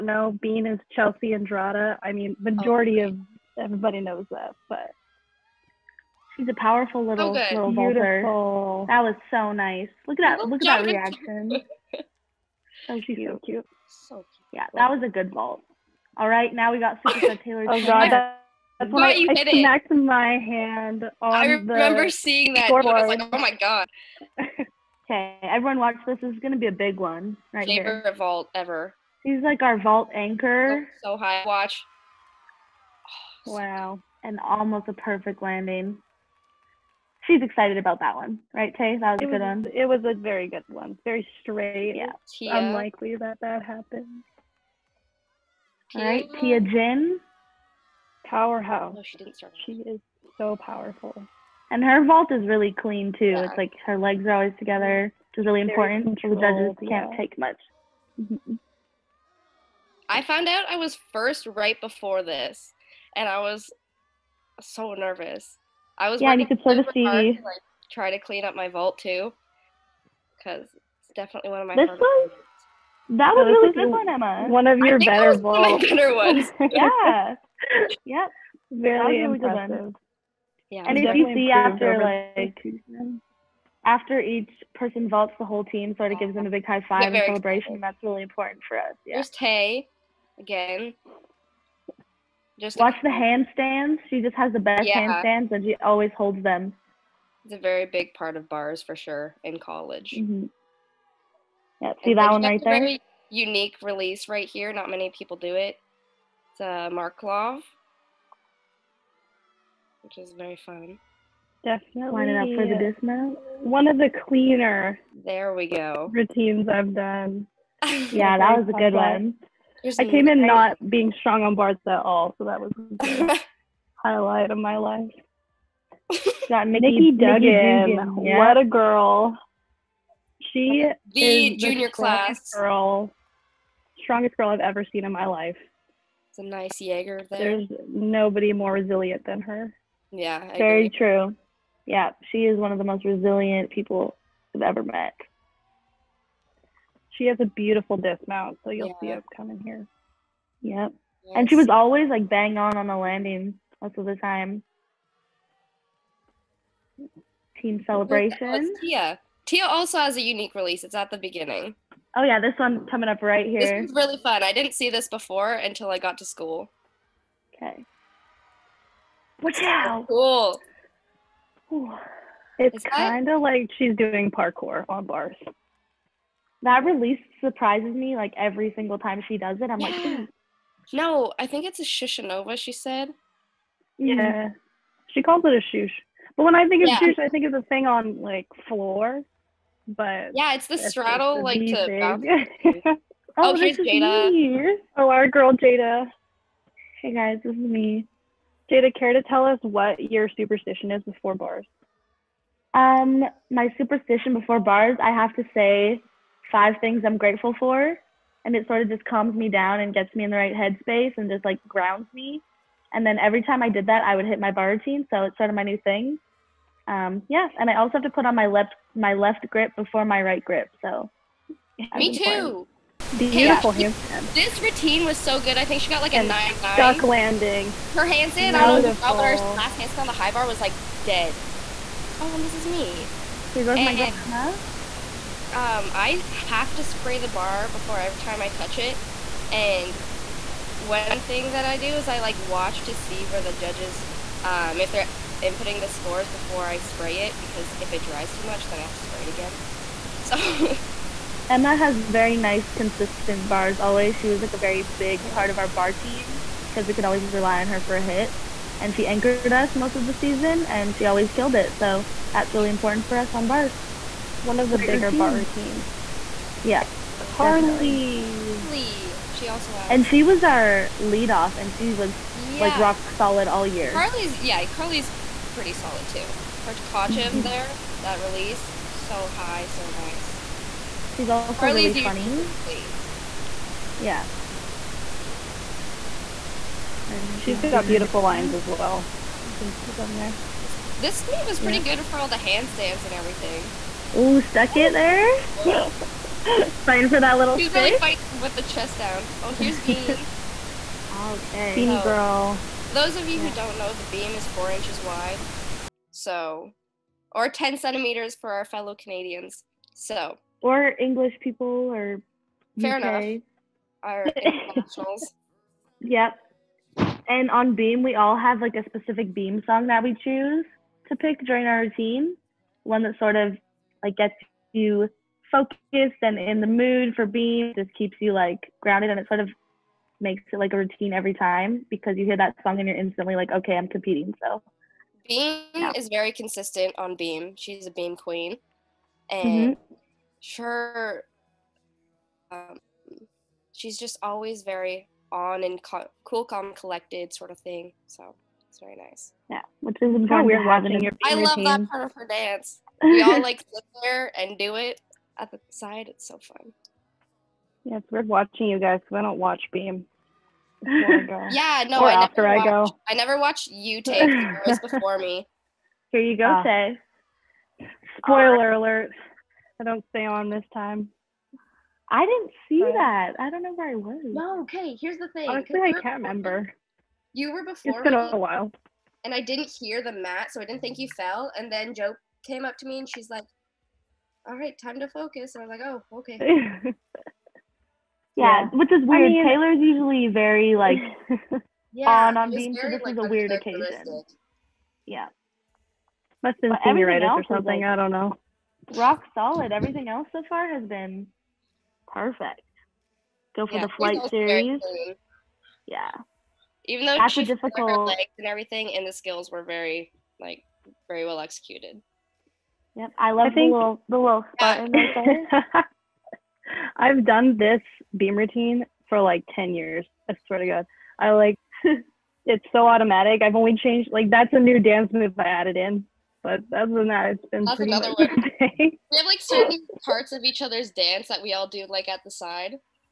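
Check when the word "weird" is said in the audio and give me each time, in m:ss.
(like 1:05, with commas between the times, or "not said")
5:50, 5:58, 6:29, 6:33.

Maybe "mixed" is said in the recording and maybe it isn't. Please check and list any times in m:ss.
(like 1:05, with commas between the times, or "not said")
not said.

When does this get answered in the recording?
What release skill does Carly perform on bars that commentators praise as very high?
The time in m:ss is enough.
4:36.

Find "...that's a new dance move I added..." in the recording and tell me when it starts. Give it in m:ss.
7:04.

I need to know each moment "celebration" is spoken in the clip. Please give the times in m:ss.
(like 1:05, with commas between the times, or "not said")
1:27, 2:37.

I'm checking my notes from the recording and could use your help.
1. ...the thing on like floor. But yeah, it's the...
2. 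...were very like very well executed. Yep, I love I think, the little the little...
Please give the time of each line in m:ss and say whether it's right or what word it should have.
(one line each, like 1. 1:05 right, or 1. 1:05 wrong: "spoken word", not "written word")
1. 3:07 right
2. 6:49 right.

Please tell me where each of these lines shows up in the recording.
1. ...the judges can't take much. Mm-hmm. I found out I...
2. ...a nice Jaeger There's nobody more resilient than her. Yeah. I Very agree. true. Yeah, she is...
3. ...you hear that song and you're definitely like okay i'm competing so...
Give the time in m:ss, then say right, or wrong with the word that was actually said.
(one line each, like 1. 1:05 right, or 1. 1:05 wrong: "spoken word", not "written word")
1. 0:56 right
2. 2:16 right
3. 5:32 wrong: "instantly", not "definitely".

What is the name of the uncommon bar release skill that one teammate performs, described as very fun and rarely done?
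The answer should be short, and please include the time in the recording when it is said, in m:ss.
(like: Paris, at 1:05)
Markelov, at 1:46.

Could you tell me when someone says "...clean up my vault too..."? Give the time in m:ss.
1:08.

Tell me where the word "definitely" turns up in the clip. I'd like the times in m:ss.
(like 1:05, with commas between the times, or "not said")
1:11, 1:51.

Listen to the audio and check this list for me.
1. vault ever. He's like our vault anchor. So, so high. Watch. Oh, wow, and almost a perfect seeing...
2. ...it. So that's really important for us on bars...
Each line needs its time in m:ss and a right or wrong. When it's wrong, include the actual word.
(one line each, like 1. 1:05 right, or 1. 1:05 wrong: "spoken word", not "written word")
1. 0:28 wrong: "landing", not "seeing"
2. 4:21 right.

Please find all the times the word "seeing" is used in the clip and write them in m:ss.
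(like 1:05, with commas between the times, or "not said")
0:22.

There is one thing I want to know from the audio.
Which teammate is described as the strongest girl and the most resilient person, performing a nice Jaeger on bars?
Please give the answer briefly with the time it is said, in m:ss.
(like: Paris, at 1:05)
Nikki Duggan, at 2:06.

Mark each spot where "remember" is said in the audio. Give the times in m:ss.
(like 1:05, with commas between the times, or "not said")
0:21, 6:16.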